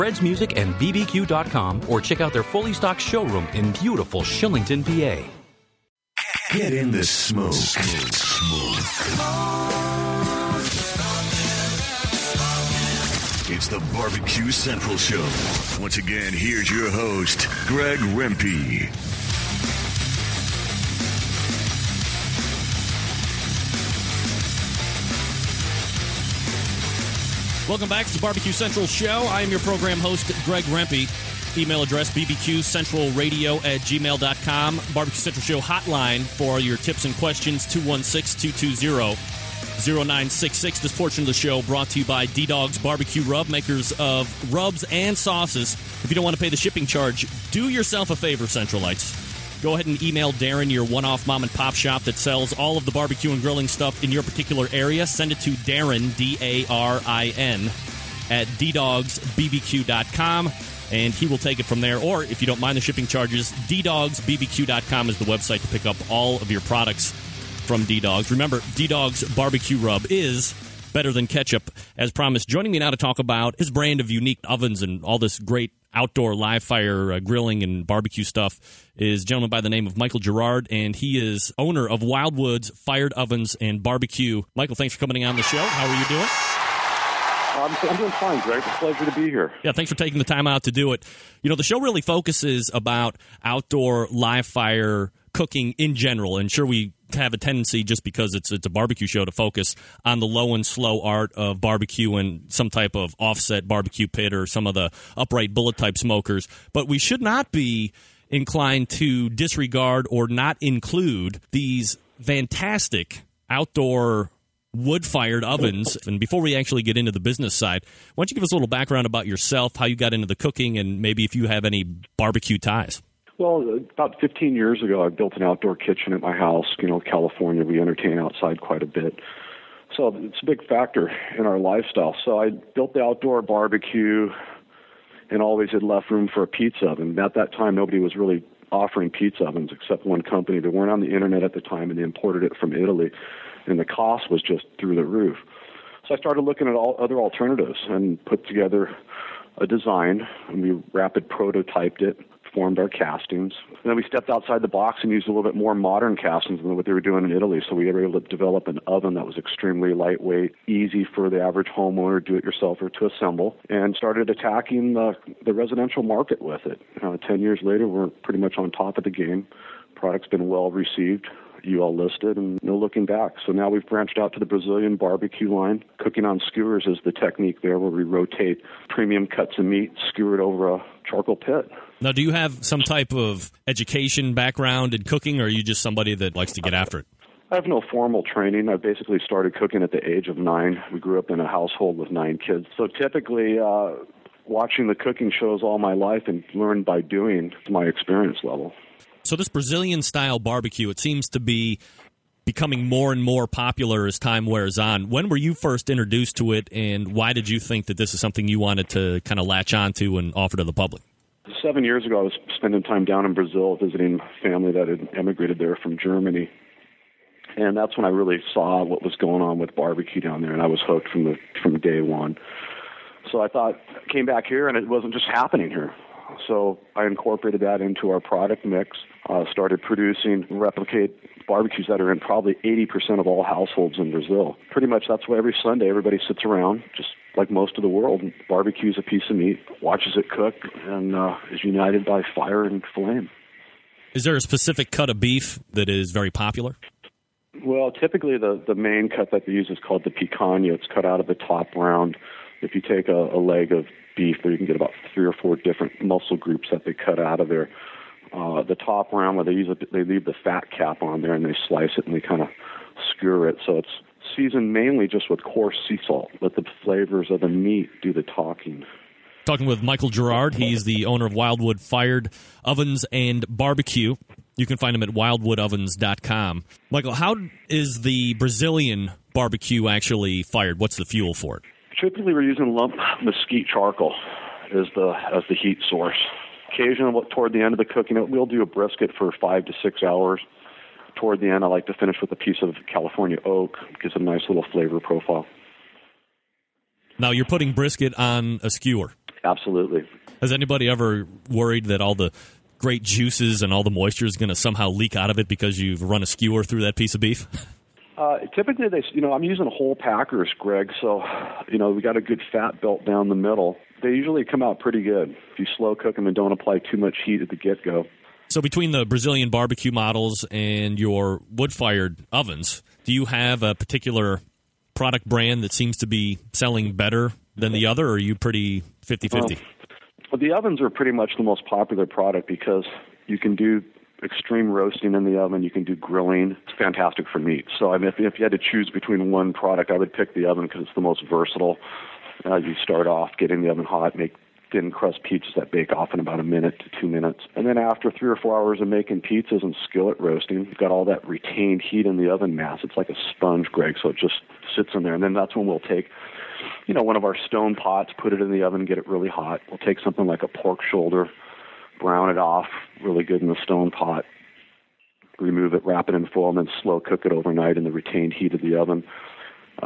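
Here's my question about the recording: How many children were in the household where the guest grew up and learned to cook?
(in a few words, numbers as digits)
9.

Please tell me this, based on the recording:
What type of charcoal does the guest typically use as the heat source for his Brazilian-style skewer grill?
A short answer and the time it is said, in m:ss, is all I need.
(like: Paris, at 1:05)
lump mesquite charcoal, at 4:42.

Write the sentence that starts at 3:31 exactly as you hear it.
Seven years ago, I was spending time down in Brazil visiting family that had emigrated there from Germany.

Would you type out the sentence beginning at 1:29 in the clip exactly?
Yeah, thanks for taking the time out to do it.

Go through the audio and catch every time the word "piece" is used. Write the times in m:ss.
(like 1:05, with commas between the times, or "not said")
3:59, 4:52, 5:06.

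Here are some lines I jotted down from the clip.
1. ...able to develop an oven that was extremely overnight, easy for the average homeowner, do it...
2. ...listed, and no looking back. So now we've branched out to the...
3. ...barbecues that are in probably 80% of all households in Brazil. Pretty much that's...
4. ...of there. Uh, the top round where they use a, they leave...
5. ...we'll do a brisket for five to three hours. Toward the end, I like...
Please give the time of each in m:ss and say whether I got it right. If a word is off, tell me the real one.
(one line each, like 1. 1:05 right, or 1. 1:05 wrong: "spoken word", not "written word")
1. 2:38 wrong: "lightweight", not "overnight"
2. 2:51 right
3. 3:51 right
4. 4:17 right
5. 4:48 wrong: "six", not "three".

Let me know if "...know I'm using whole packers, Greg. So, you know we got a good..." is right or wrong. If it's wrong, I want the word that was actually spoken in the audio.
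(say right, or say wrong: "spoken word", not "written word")
right.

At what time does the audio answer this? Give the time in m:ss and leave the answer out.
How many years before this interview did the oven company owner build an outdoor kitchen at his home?
2:04.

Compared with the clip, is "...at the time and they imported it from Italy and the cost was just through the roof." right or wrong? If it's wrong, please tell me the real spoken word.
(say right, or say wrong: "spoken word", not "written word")
right.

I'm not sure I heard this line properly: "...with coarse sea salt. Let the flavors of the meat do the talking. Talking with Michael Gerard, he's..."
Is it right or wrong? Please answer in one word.
right.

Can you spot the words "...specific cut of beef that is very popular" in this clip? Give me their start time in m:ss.
4:04.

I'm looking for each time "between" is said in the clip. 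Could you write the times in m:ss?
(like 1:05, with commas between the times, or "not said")
5:18, 5:38.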